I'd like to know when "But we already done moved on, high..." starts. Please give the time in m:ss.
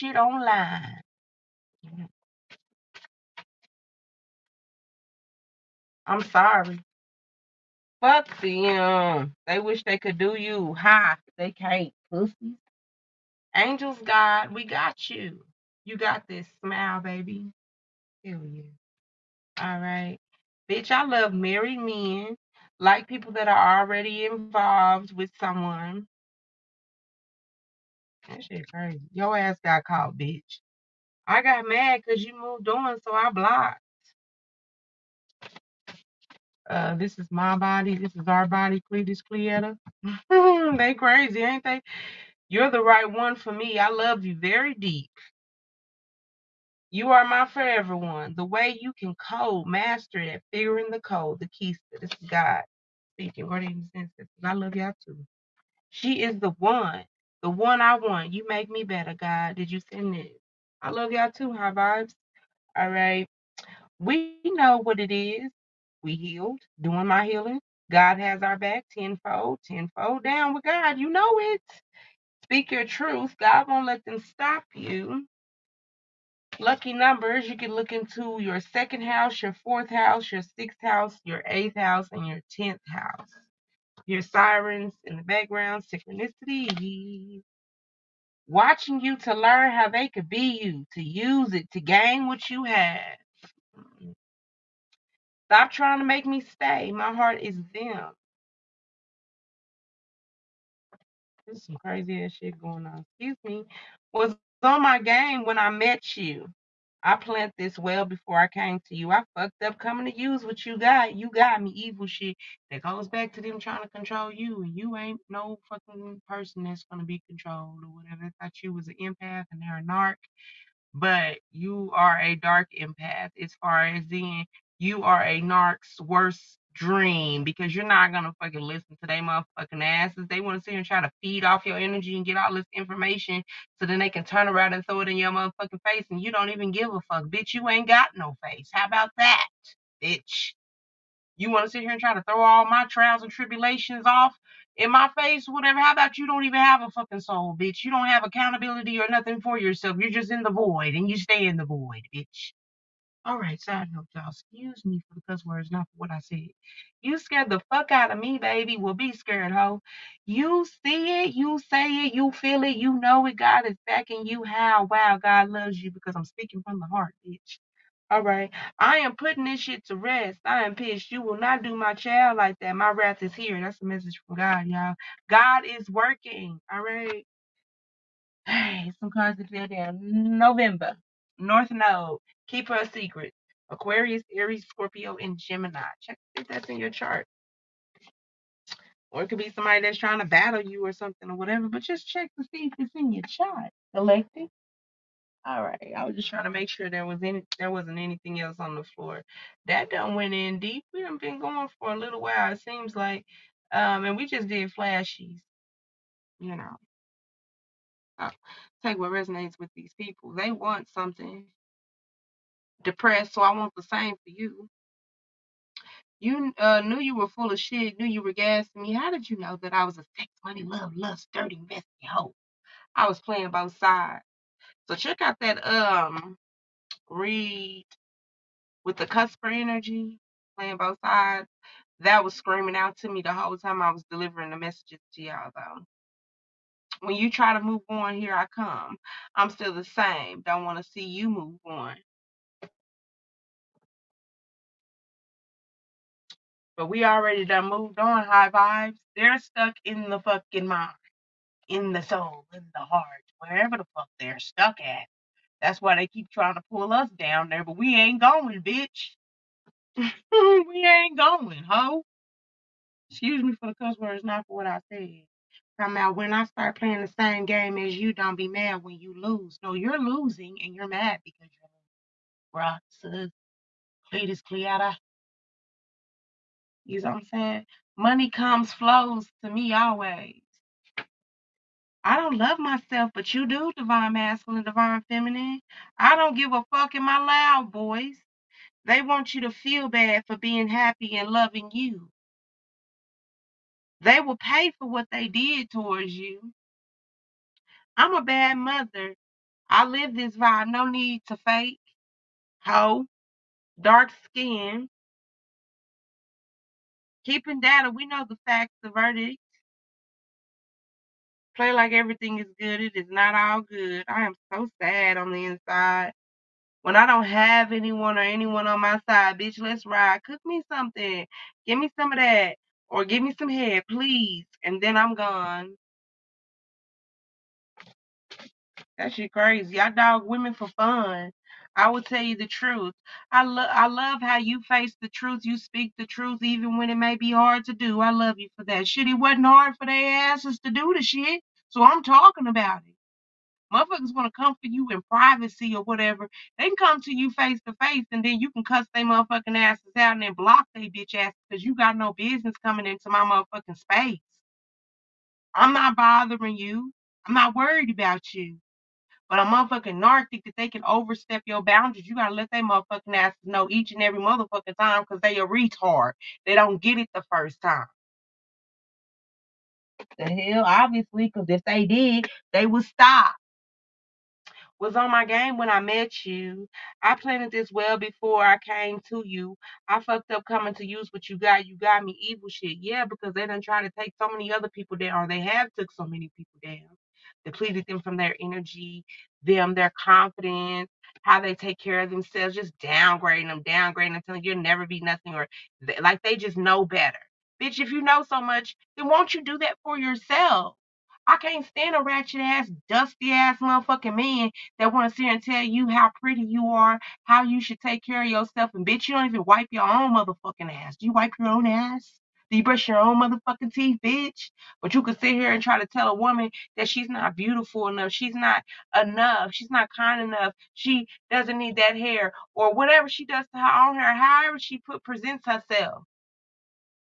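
4:06.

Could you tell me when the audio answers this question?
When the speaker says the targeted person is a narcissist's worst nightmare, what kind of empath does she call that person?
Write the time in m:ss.
2:02.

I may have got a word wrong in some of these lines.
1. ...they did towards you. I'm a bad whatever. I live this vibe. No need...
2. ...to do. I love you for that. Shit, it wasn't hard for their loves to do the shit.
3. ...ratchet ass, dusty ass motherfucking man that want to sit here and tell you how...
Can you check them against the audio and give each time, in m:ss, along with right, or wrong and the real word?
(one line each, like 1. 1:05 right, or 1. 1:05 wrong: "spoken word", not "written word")
1. 4:55 wrong: "mother", not "whatever"
2. 5:37 wrong: "asses", not "loves"
3. 6:42 right.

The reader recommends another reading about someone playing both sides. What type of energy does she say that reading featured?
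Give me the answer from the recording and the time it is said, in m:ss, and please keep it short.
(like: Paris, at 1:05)
cusper energy, at 3:49.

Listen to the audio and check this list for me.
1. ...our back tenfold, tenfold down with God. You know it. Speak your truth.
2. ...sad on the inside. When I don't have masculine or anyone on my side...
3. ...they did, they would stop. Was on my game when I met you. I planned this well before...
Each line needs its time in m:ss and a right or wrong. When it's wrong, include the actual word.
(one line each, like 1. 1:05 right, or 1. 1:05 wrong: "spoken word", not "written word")
1. 1:08 right
2. 5:14 wrong: "anyone", not "masculine"
3. 6:11 right.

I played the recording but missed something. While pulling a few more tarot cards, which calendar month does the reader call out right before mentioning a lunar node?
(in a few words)
November.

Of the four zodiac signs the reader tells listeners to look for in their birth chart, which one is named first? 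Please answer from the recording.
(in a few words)
Aquarius.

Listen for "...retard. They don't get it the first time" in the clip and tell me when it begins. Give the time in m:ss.
6:05.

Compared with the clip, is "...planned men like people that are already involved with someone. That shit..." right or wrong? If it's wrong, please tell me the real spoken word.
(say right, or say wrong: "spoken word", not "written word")
wrong: "married", not "planned".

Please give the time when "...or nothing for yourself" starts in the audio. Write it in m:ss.
2:28.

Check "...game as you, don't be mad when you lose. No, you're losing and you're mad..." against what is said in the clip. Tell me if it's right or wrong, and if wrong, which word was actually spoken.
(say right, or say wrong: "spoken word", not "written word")
right.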